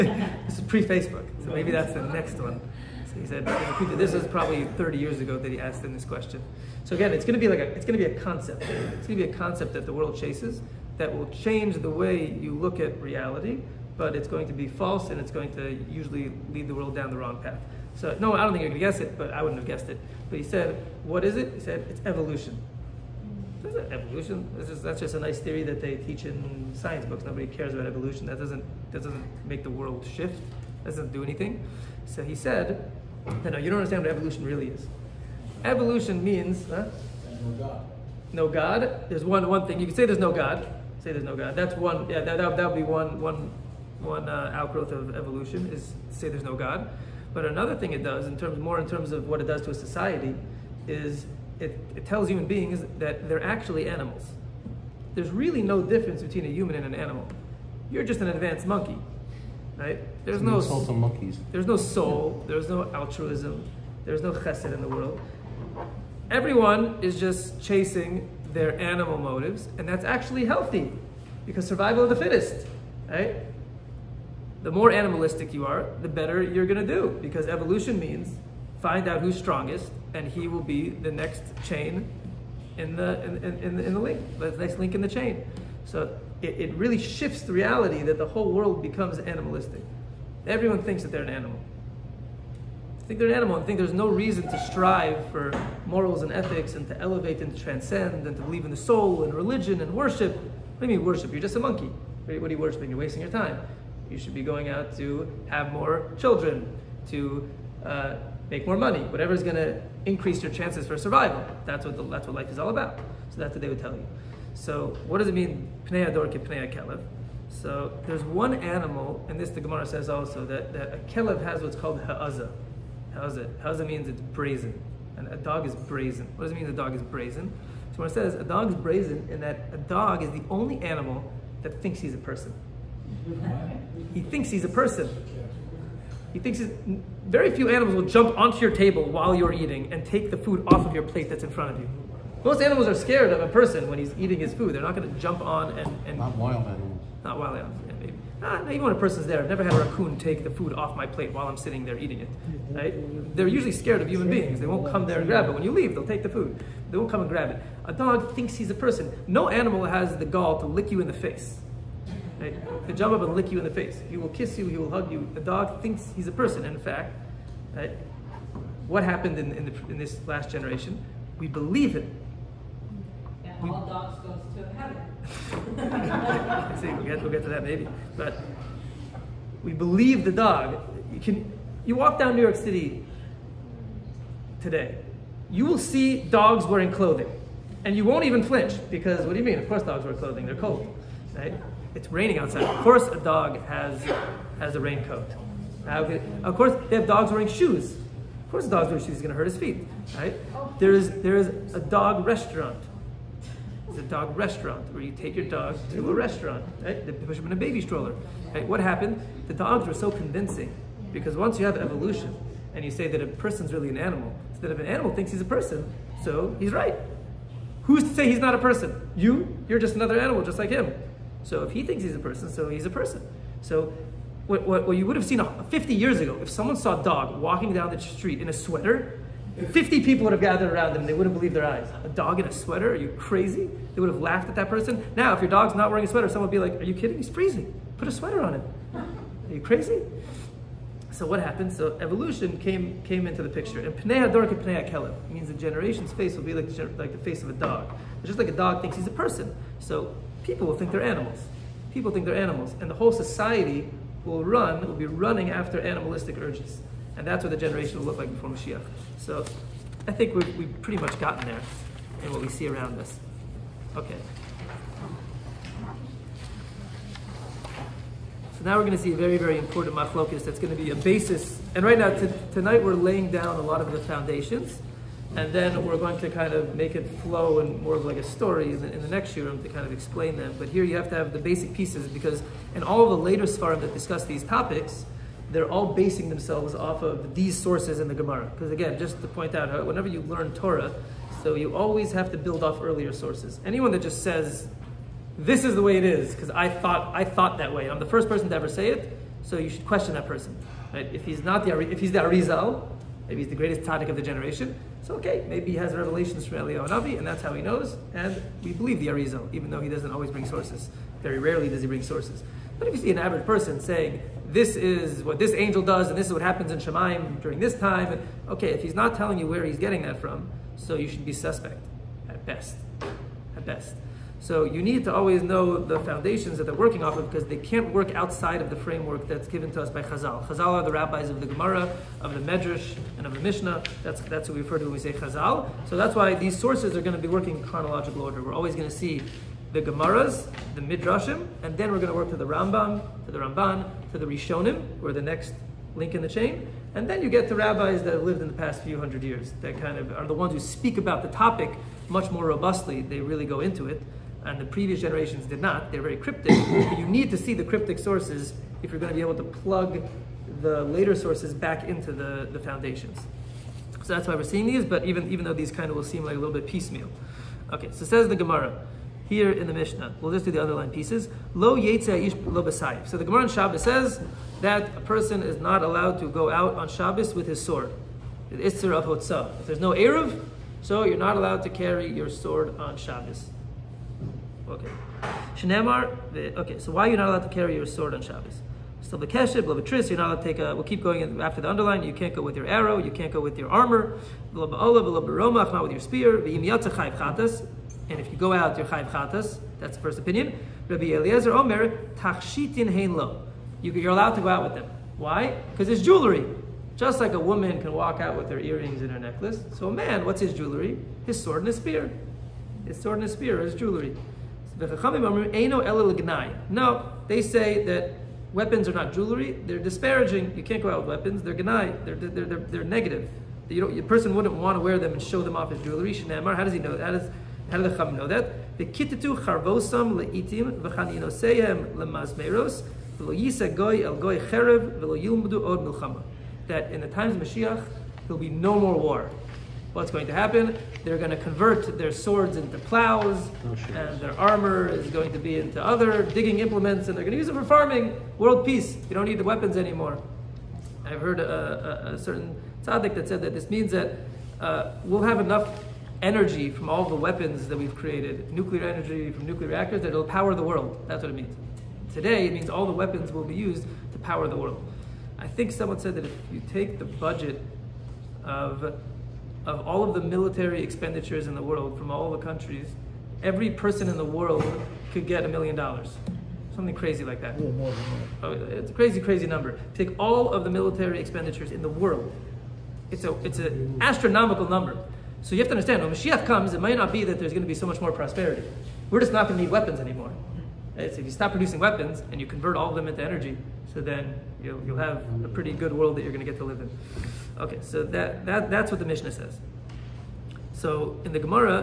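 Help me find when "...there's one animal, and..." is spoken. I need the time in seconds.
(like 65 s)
118 s.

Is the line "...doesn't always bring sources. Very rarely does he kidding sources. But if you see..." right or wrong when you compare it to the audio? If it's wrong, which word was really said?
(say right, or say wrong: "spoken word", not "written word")
wrong: "bring", not "kidding".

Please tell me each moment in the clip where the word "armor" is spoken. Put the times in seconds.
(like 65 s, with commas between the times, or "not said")
393 s, 444 s.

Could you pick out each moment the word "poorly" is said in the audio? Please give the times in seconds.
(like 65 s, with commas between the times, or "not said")
not said.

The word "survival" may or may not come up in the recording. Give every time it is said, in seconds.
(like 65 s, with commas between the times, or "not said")
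71 s, 110 s.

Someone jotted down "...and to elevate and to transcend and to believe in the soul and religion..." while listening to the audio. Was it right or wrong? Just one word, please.
right.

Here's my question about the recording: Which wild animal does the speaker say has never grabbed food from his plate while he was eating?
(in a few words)
Raccoon.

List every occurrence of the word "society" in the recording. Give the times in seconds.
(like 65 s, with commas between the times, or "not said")
49 s, 253 s.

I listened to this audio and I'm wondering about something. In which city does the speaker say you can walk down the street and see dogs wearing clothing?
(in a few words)
New York City.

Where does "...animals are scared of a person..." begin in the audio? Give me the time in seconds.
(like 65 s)
142 s.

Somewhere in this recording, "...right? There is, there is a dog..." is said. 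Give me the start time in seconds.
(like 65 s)
200 s.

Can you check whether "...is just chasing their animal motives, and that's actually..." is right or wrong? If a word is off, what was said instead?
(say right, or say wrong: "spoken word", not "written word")
right.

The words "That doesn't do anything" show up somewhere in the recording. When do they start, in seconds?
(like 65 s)
30 s.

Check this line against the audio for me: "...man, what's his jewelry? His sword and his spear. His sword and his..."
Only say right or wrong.
right.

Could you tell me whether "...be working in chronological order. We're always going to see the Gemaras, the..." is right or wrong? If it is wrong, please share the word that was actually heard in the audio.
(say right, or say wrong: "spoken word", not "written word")
right.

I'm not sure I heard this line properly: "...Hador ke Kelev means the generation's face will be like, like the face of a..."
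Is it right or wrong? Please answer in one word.
right.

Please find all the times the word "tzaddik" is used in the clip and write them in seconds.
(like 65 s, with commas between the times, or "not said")
303 s, 452 s.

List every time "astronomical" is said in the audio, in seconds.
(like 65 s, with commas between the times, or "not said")
484 s.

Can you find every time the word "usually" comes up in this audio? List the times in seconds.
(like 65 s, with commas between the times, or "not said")
15 s, 153 s.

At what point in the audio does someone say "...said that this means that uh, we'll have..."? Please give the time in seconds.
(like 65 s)
453 s.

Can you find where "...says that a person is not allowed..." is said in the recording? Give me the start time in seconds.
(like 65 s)
373 s.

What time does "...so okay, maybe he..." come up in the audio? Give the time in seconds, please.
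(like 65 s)
305 s.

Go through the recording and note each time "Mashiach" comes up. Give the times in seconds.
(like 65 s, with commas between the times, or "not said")
258 s, 437 s, 486 s.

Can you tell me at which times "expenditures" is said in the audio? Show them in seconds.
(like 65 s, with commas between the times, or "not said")
470 s, 481 s.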